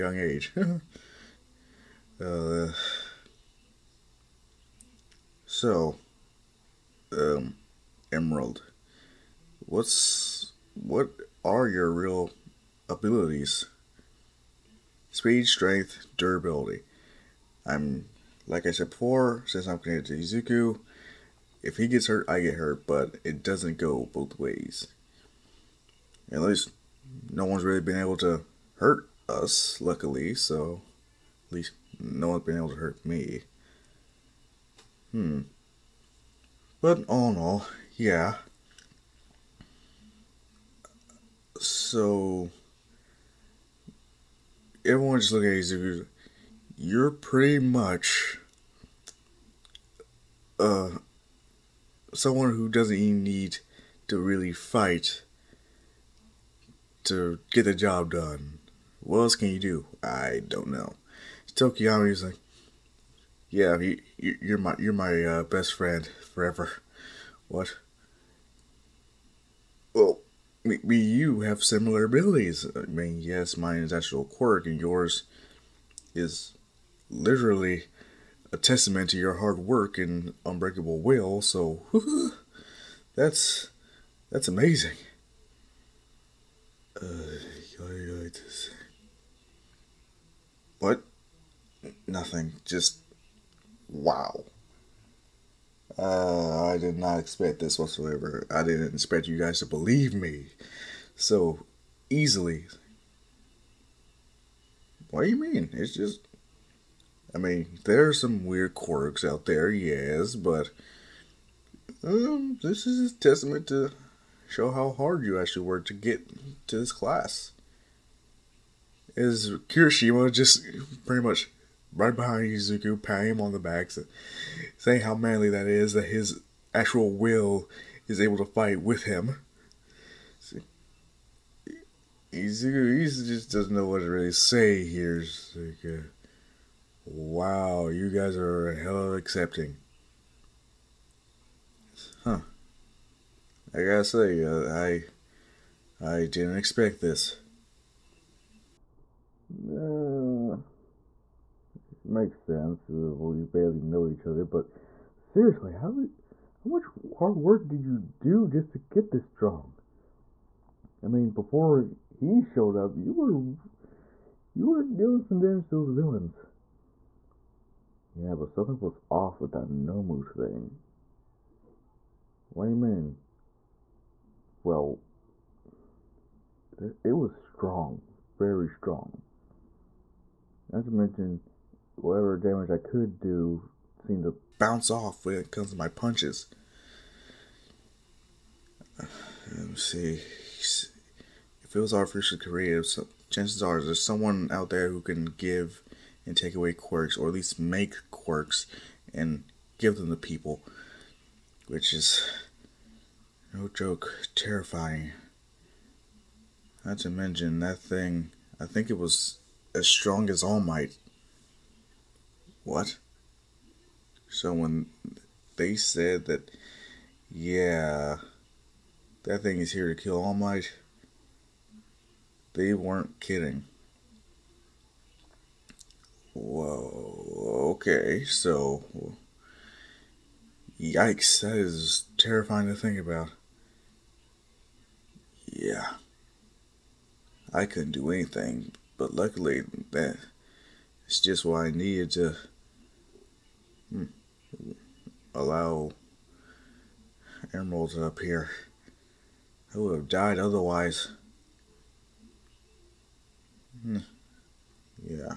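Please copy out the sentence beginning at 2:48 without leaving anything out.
Yeah, but something was off with that Nomu thing.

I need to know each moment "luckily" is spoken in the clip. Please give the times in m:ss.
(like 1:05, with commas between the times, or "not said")
0:29, 3:59.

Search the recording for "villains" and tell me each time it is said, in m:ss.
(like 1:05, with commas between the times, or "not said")
2:45.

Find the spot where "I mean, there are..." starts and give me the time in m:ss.
1:47.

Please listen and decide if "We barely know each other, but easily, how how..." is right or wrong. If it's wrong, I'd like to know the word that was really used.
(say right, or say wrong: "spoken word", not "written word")
wrong: "seriously", not "easily".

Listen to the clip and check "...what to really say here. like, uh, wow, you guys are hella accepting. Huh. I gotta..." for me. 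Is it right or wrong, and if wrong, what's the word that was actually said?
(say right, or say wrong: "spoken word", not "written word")
right.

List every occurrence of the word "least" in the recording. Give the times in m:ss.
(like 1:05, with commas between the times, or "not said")
0:26, 0:31, 3:17.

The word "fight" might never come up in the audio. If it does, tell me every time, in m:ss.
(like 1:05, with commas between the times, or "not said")
0:54, 2:08.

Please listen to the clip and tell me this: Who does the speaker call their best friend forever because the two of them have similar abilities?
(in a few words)
Tokoyami.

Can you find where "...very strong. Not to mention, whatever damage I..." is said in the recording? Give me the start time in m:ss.
2:58.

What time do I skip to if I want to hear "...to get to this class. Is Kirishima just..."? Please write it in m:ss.
1:55.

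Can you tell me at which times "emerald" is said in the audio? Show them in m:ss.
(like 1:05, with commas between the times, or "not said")
0:08, 4:07.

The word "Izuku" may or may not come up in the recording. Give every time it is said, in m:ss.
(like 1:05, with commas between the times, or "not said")
0:20, 2:02, 2:12.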